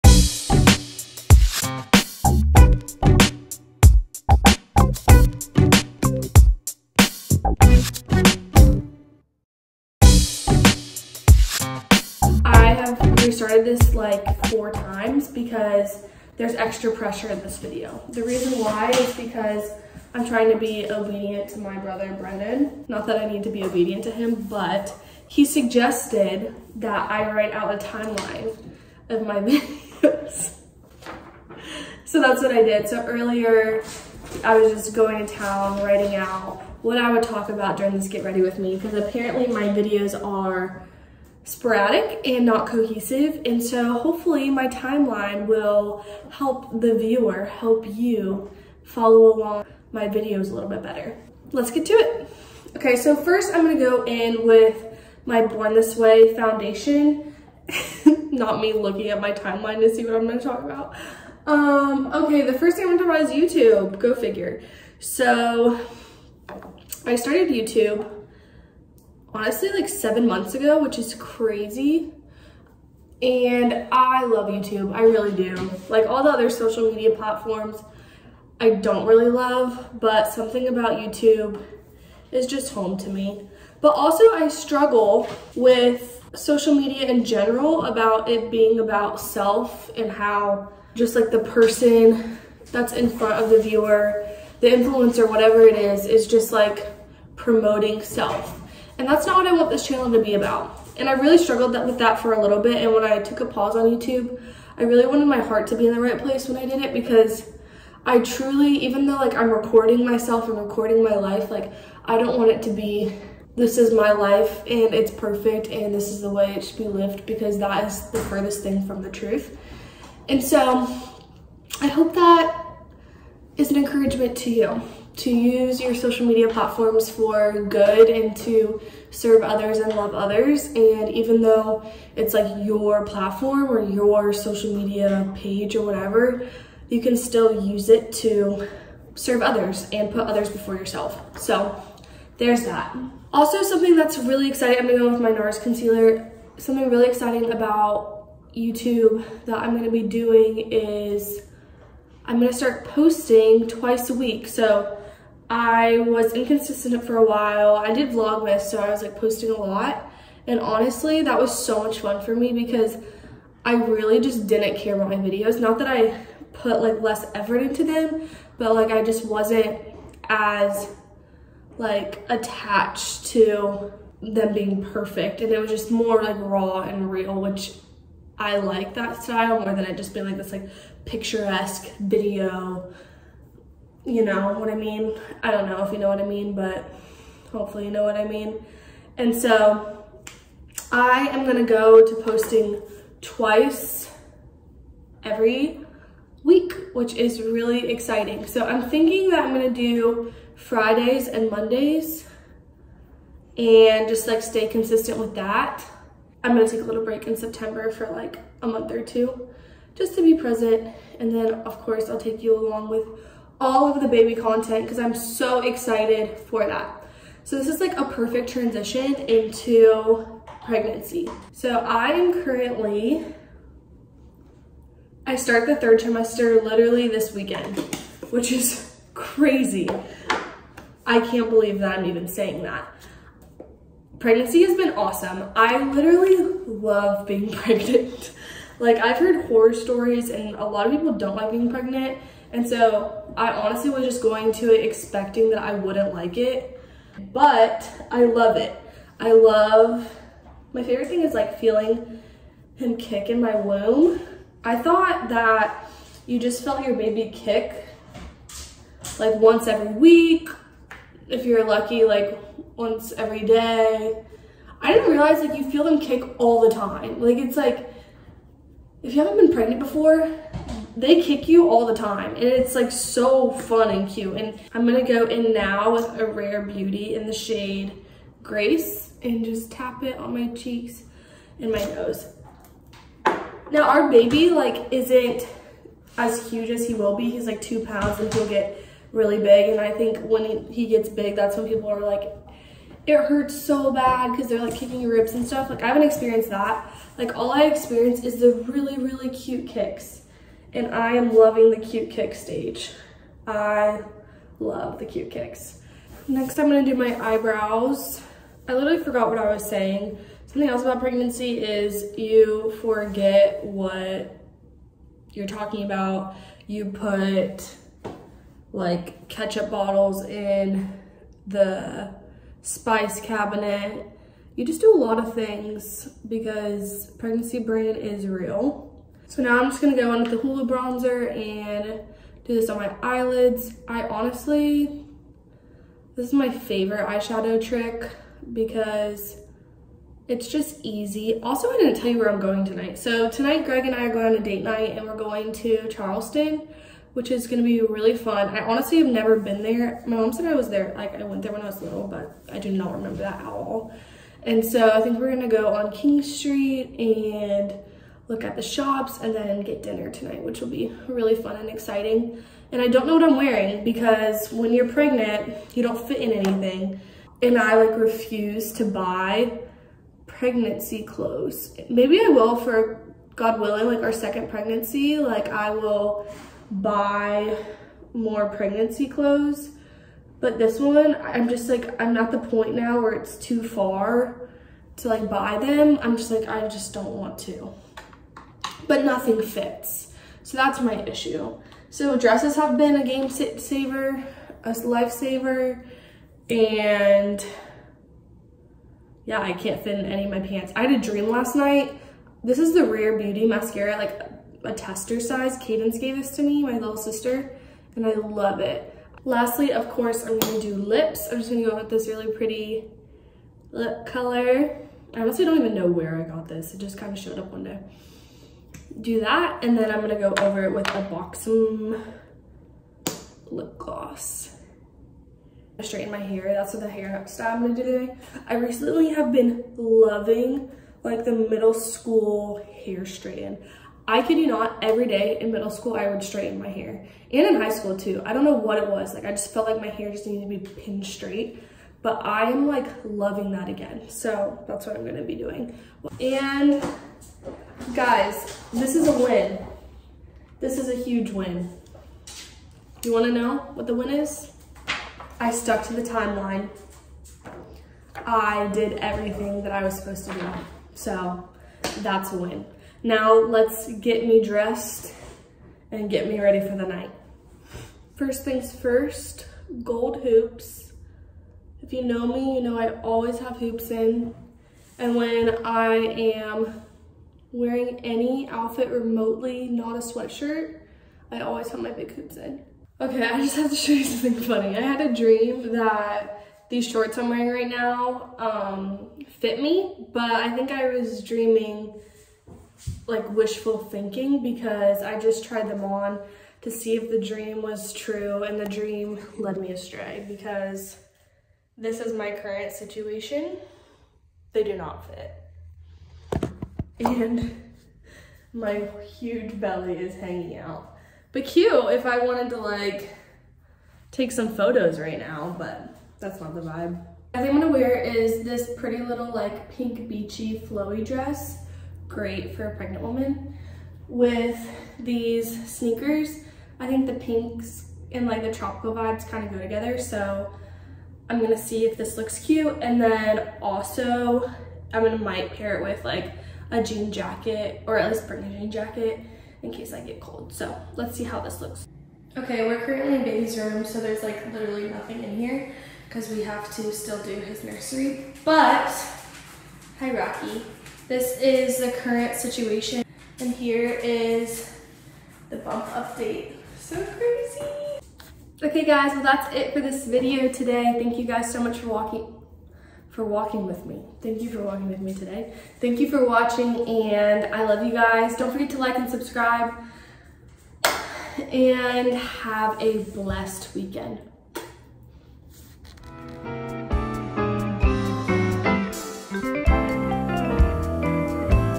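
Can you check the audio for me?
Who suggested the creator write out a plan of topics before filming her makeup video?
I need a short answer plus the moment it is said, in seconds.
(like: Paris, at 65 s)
Brendan, at 21 s.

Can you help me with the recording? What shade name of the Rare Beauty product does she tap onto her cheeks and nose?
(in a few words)
Grace.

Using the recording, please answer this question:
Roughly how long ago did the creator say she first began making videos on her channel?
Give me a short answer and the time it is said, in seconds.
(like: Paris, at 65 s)
7 months, at 69 s.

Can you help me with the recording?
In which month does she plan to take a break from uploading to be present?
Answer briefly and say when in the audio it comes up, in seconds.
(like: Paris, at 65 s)
September, at 207 s.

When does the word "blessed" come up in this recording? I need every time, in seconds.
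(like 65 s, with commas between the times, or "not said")
573 s.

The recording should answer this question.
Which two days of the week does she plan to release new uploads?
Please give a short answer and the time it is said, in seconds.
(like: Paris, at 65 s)
Fridays and Mondays, at 200 s.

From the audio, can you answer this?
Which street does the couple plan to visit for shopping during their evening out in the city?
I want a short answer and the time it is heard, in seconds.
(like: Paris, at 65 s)
King Street, at 355 s.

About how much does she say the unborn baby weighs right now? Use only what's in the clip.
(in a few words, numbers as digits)
2 pounds.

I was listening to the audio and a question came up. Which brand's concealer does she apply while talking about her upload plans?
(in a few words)
NARS.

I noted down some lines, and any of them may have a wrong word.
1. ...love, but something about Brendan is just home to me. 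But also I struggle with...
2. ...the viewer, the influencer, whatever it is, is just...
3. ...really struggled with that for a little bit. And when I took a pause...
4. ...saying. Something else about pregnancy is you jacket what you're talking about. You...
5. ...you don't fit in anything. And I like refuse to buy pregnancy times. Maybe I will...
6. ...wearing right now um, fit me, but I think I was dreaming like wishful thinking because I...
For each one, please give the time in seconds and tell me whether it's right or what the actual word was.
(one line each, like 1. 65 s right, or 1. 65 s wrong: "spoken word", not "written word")
1. 79 s wrong: "YouTube", not "Brendan"
2. 93 s right
3. 101 s right
4. 309 s wrong: "forget", not "jacket"
5. 365 s wrong: "clothes", not "times"
6. 487 s right.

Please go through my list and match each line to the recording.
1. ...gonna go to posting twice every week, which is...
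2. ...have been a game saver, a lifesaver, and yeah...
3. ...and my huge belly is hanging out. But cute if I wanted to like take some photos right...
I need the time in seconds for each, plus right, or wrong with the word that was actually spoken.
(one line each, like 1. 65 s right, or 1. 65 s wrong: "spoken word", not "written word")
1. 191 s right
2. 392 s right
3. 507 s right.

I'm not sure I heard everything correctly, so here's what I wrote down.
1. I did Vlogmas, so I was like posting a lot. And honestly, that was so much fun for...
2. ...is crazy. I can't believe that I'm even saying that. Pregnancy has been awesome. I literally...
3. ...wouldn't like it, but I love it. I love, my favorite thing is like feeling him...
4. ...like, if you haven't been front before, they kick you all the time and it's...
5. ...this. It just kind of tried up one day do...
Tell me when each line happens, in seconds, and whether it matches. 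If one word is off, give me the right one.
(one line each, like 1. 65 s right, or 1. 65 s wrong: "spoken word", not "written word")
1. 157 s right
2. 228 s right
3. 245 s right
4. 267 s wrong: "pregnant", not "front"
5. 416 s wrong: "showed", not "tried".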